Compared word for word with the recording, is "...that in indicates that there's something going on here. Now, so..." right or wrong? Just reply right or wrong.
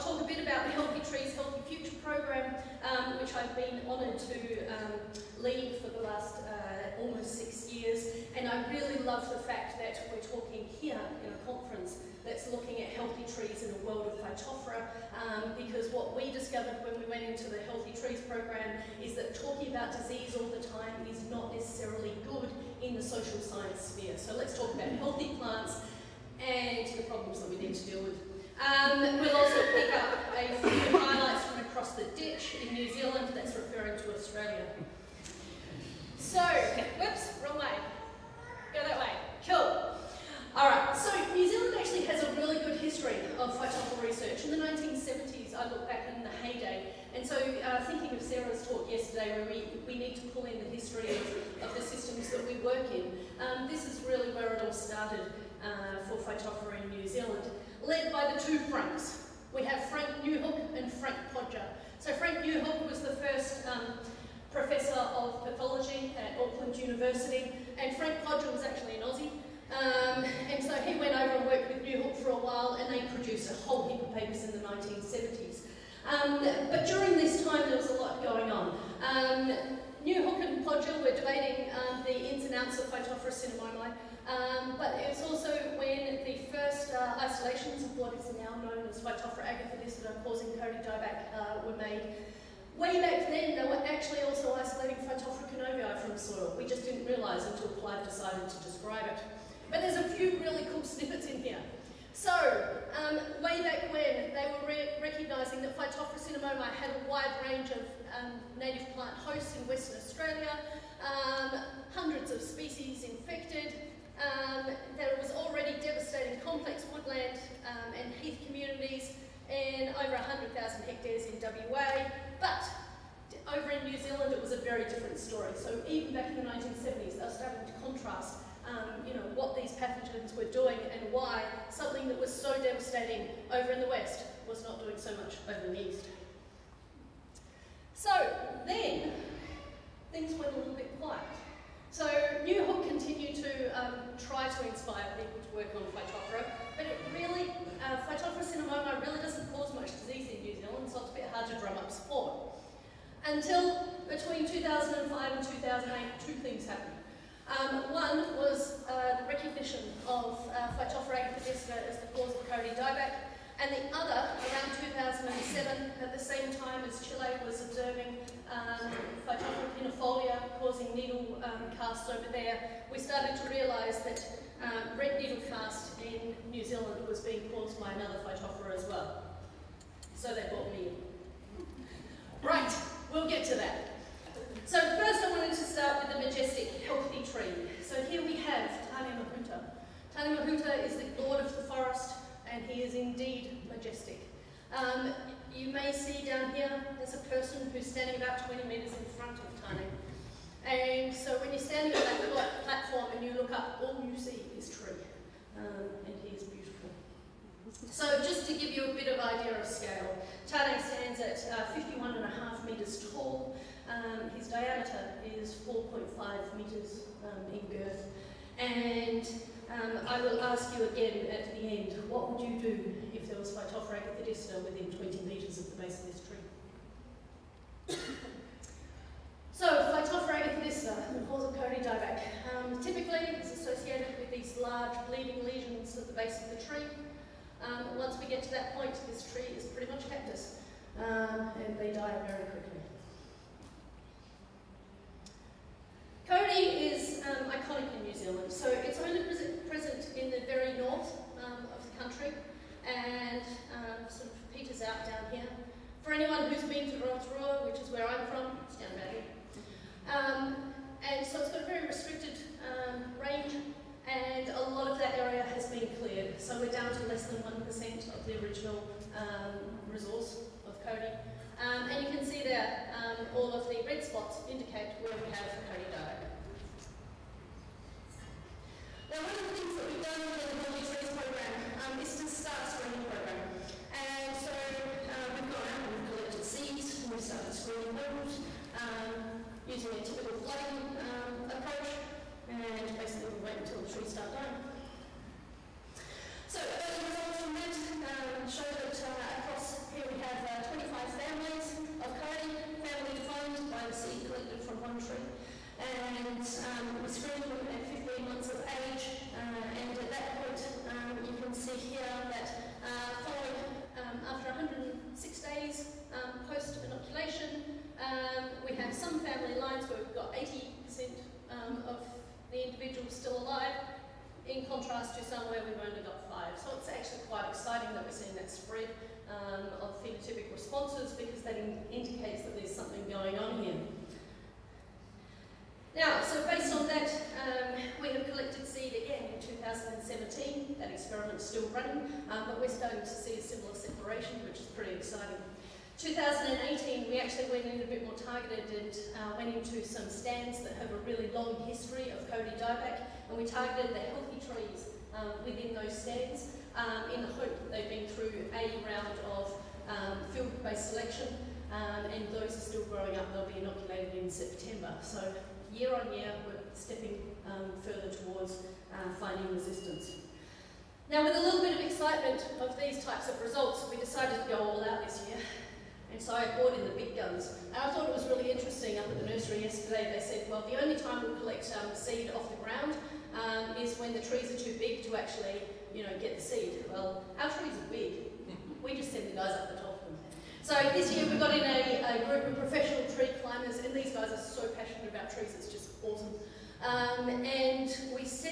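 right.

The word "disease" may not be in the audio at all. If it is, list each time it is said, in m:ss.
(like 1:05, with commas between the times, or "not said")
0:19, 2:30.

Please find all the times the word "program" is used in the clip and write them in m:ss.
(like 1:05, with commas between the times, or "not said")
0:02, 0:18.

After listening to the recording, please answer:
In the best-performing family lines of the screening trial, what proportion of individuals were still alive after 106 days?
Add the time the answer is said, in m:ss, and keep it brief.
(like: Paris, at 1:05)
80%, at 5:20.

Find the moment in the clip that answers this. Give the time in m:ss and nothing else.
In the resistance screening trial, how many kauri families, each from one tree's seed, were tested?
5:00.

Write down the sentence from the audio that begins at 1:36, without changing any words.
We just didn't realise until Clive decided to describe it.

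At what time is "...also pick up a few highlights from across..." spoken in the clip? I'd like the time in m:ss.
0:29.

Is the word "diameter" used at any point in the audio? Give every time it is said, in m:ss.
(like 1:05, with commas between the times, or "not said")
3:34.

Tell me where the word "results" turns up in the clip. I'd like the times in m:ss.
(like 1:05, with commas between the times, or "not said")
4:57, 6:13.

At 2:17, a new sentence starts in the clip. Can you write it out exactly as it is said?
So then, things went a little bit quiet.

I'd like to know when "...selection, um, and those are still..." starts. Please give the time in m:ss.
6:00.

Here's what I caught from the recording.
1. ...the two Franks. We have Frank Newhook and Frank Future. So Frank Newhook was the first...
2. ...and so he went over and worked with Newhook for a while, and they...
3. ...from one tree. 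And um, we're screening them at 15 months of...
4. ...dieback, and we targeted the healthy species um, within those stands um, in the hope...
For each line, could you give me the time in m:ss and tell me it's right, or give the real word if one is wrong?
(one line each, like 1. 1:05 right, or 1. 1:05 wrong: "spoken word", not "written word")
1. 0:58 wrong: "Podger", not "Future"
2. 1:10 right
3. 5:04 right
4. 5:52 wrong: "trees", not "species".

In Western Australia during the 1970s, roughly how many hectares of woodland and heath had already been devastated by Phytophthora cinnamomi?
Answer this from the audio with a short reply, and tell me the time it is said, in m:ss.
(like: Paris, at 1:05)
100,000 hectares, at 2:00.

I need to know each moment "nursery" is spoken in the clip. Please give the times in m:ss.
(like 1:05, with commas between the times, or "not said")
6:19.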